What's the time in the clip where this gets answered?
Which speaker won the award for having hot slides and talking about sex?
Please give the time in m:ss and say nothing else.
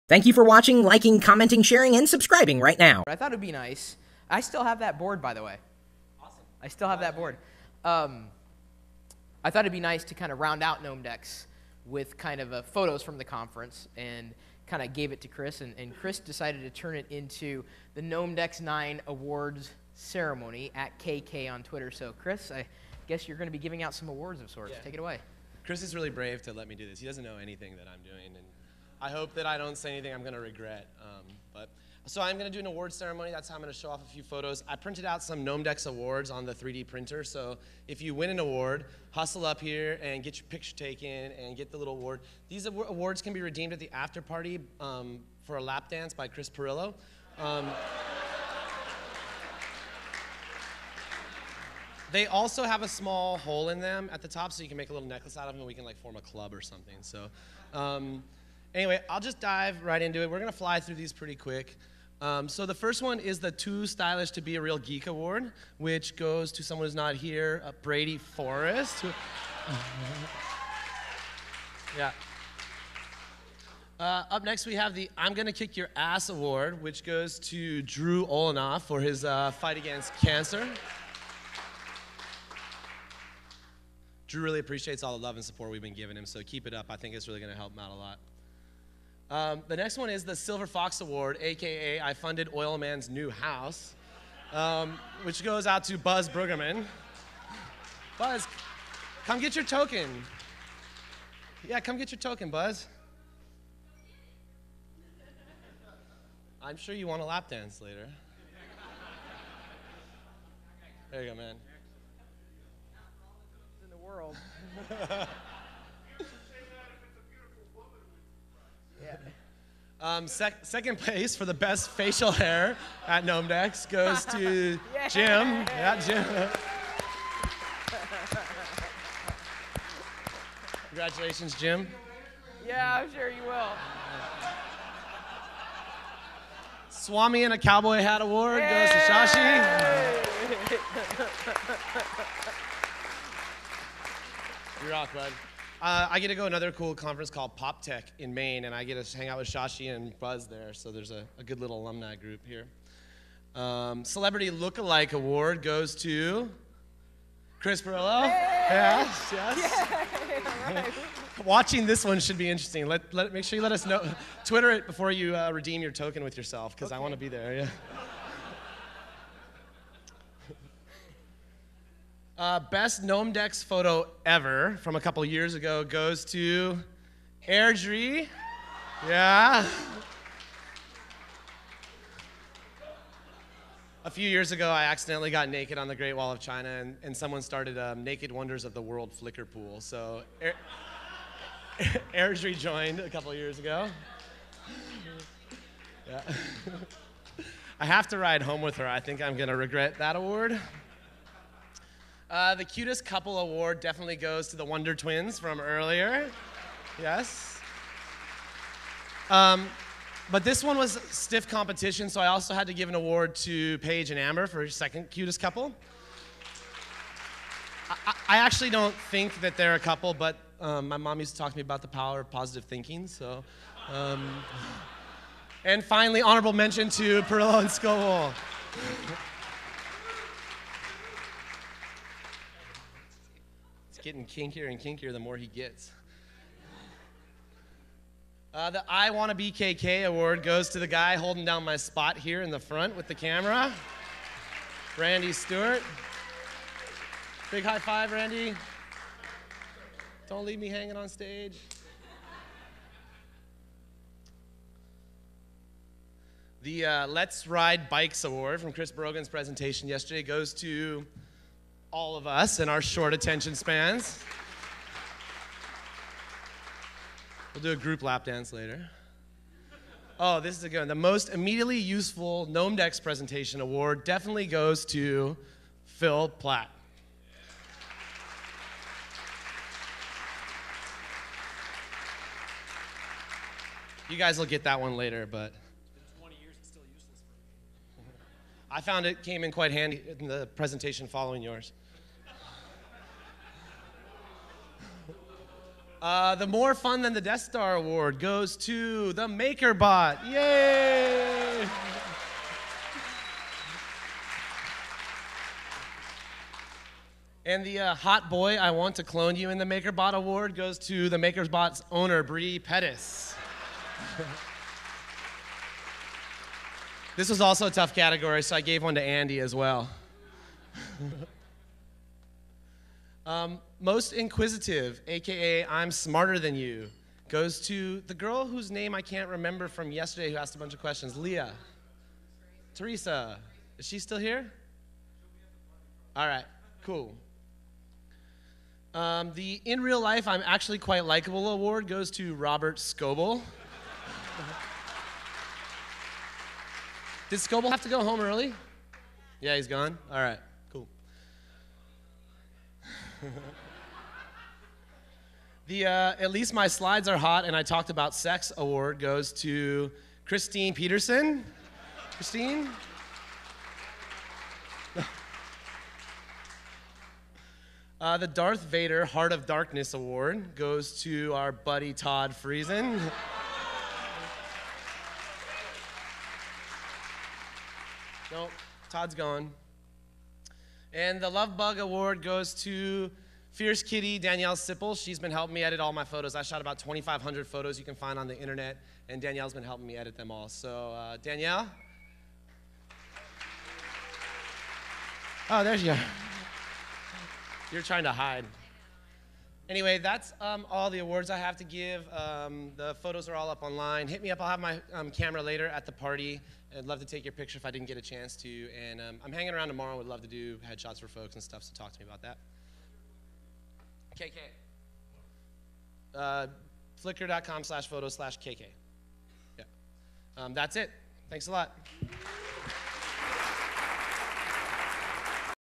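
6:00.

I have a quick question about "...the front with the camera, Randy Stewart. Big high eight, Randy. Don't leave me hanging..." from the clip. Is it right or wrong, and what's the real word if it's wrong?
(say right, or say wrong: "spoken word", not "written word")
wrong: "five", not "eight".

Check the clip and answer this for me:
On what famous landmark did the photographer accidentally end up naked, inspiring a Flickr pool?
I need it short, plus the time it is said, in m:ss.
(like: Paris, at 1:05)
Great Wall of China, at 3:05.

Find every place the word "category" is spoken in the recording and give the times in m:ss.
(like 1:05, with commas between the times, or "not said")
5:17.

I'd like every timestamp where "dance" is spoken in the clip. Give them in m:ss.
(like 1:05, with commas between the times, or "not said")
0:45, 1:47, 4:28.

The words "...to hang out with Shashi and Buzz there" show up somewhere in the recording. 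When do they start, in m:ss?
2:29.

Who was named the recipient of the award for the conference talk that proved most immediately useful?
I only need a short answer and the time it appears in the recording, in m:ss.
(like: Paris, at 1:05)
Phil Plait, at 4:35.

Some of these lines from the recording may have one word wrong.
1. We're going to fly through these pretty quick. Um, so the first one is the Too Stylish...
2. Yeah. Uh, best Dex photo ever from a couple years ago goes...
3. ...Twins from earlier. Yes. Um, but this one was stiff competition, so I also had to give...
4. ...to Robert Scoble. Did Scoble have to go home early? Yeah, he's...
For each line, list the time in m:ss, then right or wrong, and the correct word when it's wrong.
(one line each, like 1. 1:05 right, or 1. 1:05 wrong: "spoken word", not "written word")
1. 1:00 right
2. 2:47 right
3. 3:24 right
4. 5:42 right.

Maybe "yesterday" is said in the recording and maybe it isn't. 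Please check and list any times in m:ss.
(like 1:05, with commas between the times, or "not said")
4:19, 5:29.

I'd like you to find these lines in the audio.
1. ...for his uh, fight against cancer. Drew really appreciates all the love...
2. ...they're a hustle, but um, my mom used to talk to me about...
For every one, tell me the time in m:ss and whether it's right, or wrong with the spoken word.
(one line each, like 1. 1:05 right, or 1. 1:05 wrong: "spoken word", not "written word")
1. 1:18 right
2. 3:39 wrong: "couple", not "hustle".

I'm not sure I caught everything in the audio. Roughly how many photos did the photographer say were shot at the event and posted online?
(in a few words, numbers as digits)
2,500.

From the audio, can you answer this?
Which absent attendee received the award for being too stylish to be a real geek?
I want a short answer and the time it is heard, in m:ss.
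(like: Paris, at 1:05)
Brady Forrest, at 1:07.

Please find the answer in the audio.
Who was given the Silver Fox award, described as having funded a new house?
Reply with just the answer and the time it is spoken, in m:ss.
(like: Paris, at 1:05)
Buzz Bruggeman, at 1:35.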